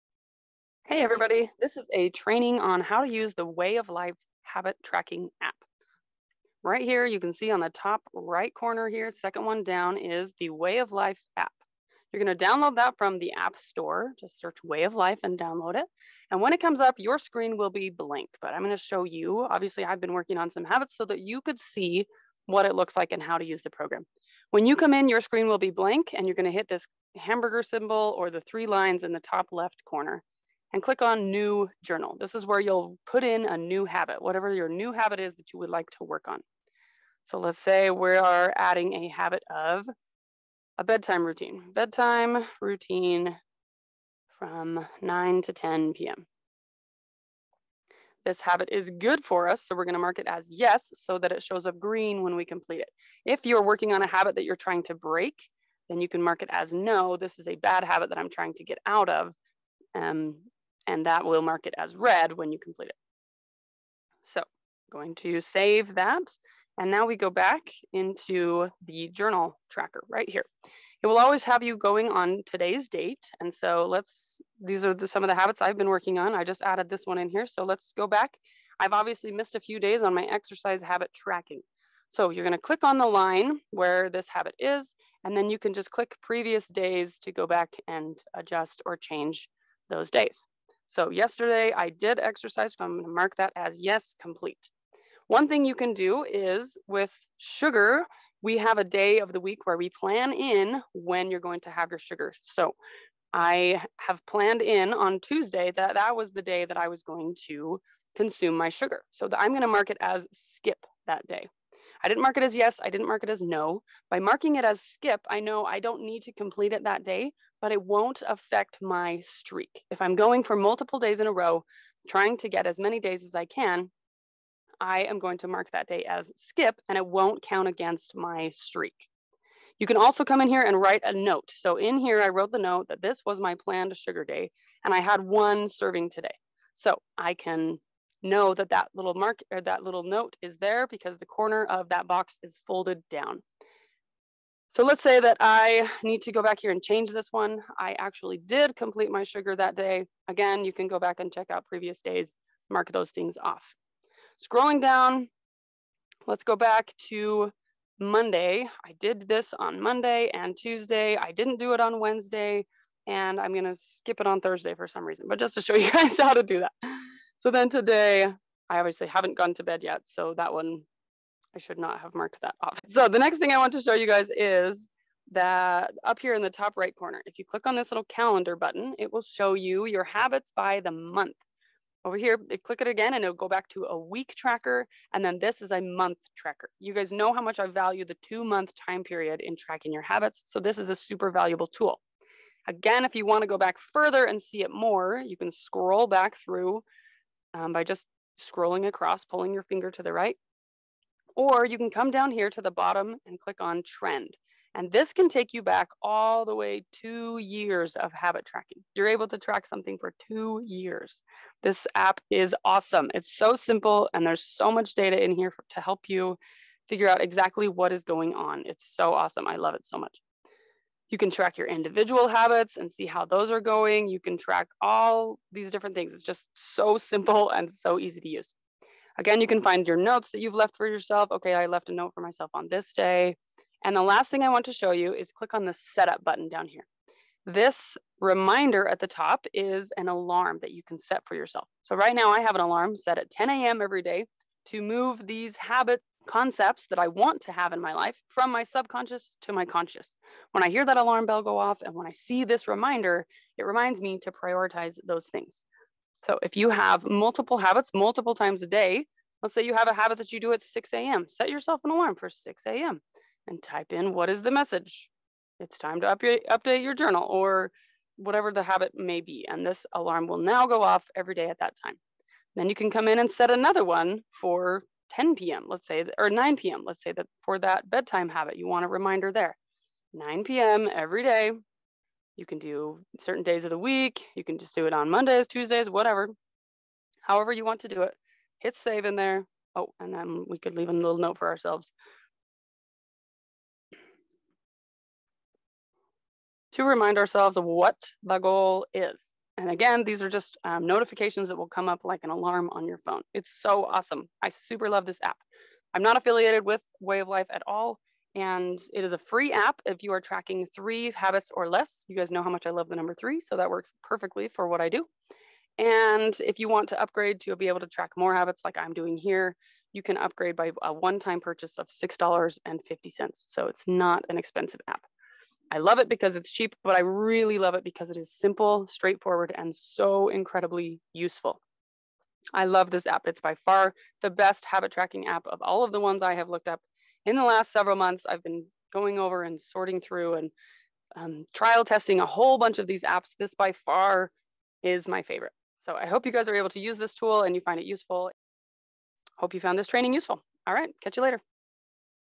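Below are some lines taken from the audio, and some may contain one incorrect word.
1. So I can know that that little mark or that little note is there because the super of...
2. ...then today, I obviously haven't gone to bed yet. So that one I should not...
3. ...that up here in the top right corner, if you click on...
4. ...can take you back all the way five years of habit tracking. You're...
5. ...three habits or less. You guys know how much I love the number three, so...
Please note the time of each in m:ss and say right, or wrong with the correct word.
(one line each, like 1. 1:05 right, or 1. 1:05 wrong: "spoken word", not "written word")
1. 2:16 wrong: "corner", not "super"
2. 2:47 right
3. 2:55 right
4. 3:25 wrong: "two", not "five"
5. 5:10 right.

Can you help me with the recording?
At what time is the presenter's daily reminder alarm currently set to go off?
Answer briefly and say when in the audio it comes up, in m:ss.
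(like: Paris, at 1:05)
10 a.m., at 4:03.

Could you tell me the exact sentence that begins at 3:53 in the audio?
And the last thing I want to show you is click on the setup button down here.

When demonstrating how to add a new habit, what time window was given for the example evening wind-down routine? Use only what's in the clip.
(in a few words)
9 to 10 p.m.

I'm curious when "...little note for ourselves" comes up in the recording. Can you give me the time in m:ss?
4:50.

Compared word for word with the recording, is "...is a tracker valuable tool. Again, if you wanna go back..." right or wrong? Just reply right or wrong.
wrong.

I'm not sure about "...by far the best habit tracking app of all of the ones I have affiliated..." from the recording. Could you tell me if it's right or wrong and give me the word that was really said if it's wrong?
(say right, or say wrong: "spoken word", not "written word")
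wrong: "looked", not "affiliated".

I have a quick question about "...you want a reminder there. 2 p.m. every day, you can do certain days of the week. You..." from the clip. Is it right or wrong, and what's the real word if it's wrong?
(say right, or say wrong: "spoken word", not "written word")
wrong: "9", not "2".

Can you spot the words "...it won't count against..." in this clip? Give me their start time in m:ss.
2:06.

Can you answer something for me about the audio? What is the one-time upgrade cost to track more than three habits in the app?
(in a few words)
$6.50.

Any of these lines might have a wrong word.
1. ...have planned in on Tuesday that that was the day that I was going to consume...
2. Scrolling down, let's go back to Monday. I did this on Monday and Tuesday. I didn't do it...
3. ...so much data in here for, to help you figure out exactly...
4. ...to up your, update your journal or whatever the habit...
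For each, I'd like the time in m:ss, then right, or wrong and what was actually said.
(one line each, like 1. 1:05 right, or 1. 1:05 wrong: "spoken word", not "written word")
1. 1:43 right
2. 2:34 right
3. 3:34 right
4. 4:26 right.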